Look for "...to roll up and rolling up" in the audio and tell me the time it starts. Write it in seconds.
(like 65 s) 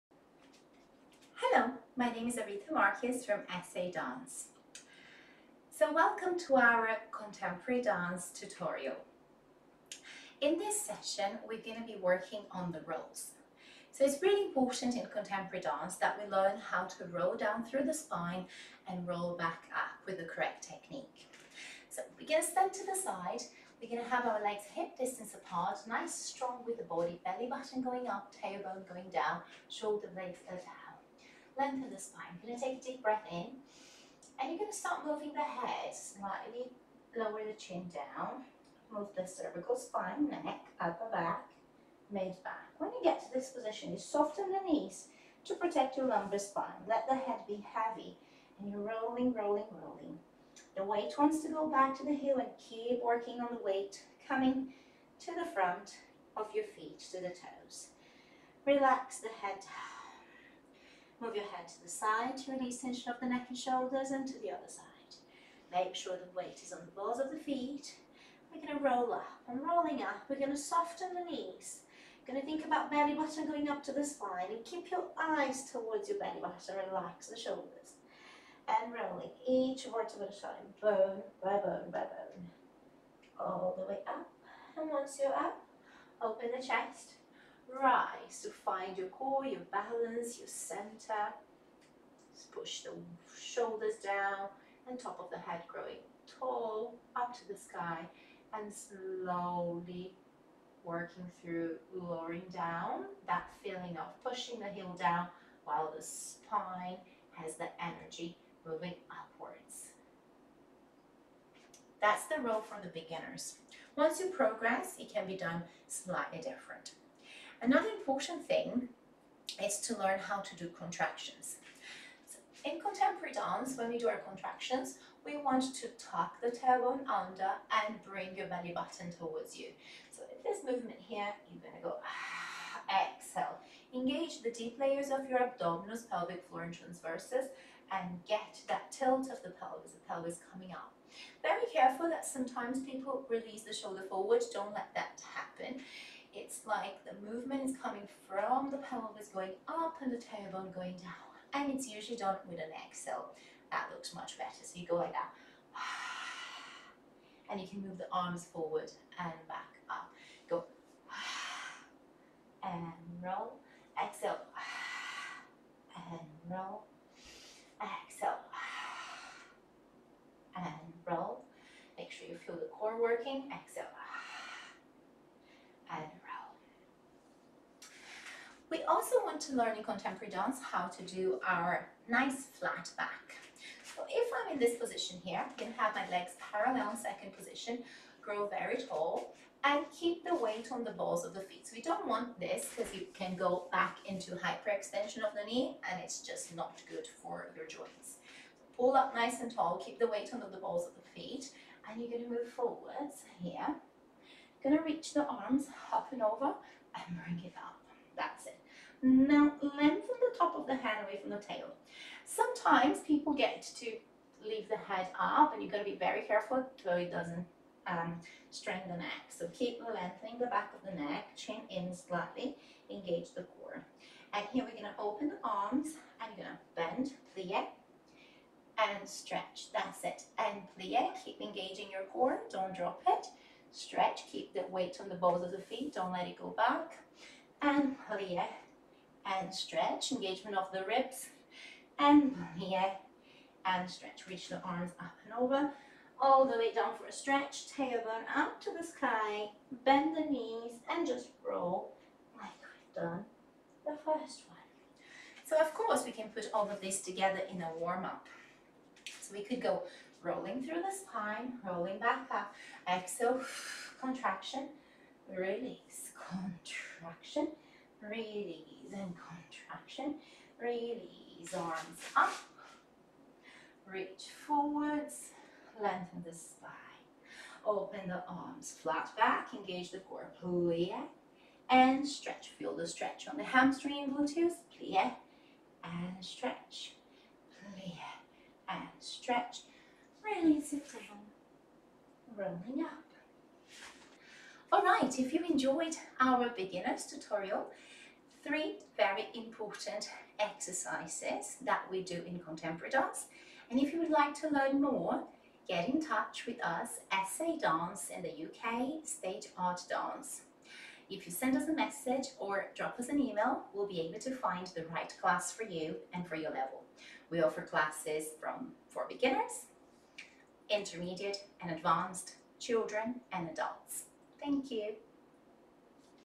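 68 s.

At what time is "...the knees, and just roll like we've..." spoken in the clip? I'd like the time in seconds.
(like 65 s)
250 s.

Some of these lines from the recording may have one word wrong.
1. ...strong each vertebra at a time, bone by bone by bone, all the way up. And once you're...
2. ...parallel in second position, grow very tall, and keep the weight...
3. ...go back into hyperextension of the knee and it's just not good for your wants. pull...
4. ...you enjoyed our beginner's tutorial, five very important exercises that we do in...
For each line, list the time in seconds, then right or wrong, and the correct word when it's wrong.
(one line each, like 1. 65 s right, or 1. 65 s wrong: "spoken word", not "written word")
1. 78 s wrong: "rolling", not "strong"
2. 186 s right
3. 193 s wrong: "joints", not "wants"
4. 295 s wrong: "three", not "five".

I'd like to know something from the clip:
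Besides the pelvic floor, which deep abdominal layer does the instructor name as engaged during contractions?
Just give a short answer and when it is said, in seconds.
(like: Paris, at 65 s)
Transverses, at 136 s.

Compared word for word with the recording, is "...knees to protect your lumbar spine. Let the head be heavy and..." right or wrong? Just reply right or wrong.
right.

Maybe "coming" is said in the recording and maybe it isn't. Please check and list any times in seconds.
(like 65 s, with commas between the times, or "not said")
54 s, 140 s, 147 s.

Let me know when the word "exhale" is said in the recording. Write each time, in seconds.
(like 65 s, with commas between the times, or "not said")
133 s, 152 s, 164 s, 168 s, 173 s, 262 s.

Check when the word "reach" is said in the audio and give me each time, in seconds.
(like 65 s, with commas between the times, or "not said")
204 s, 244 s, 273 s.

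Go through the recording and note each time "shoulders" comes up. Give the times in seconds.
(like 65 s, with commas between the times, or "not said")
29 s, 63 s, 77 s, 93 s, 143 s.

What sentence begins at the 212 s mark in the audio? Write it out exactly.
Sometimes people get to leave the head up and you've got to be very careful so it doesn't um, strain the neck.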